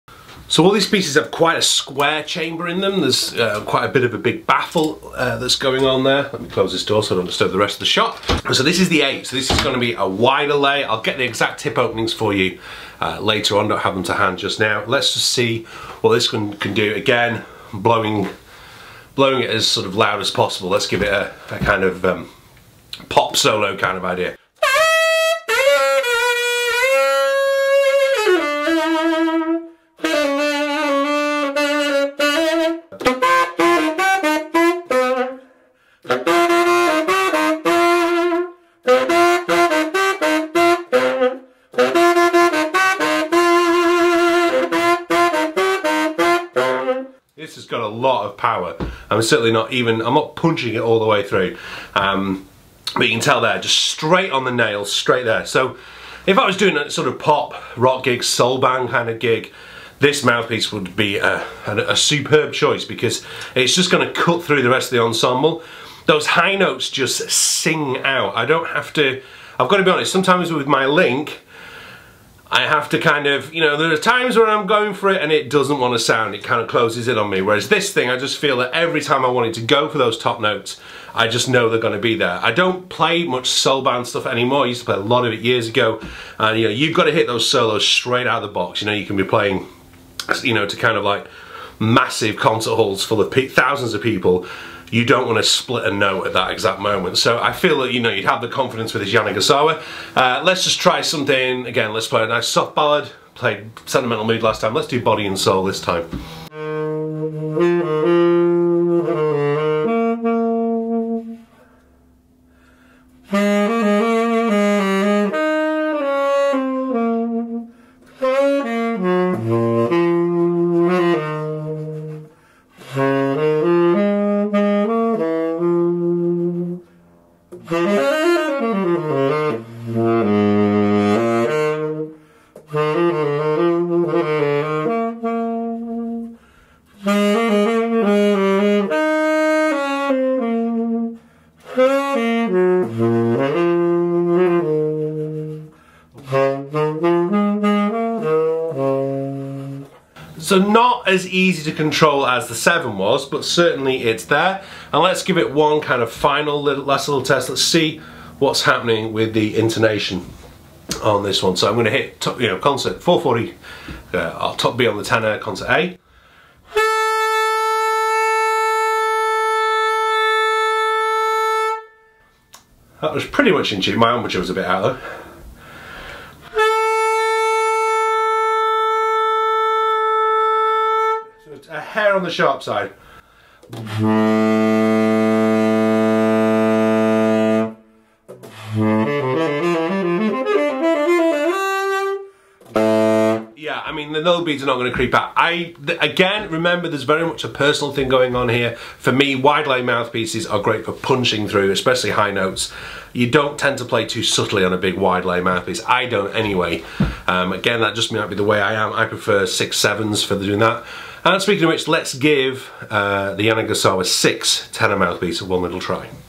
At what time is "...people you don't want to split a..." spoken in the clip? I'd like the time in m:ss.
1:34.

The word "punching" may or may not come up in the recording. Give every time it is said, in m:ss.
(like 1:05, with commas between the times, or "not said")
0:50, 3:20.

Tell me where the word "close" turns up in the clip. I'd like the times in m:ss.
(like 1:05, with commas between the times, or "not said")
0:06, 1:16.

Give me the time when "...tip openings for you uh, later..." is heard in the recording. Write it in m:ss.
0:11.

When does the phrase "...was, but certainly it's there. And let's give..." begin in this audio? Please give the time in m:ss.
2:32.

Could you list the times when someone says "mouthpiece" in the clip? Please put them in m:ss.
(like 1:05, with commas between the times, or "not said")
1:00, 3:19, 3:25, 3:34.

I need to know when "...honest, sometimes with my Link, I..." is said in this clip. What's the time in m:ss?
1:09.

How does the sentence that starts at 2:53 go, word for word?
That was pretty much in tune.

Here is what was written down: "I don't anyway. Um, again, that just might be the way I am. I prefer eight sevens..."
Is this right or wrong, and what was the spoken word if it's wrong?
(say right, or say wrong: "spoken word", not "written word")
wrong: "six", not "eight".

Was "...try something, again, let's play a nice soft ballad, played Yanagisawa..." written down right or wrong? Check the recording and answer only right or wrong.
wrong.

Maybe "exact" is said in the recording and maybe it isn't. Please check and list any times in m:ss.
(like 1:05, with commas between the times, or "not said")
0:11, 1:36.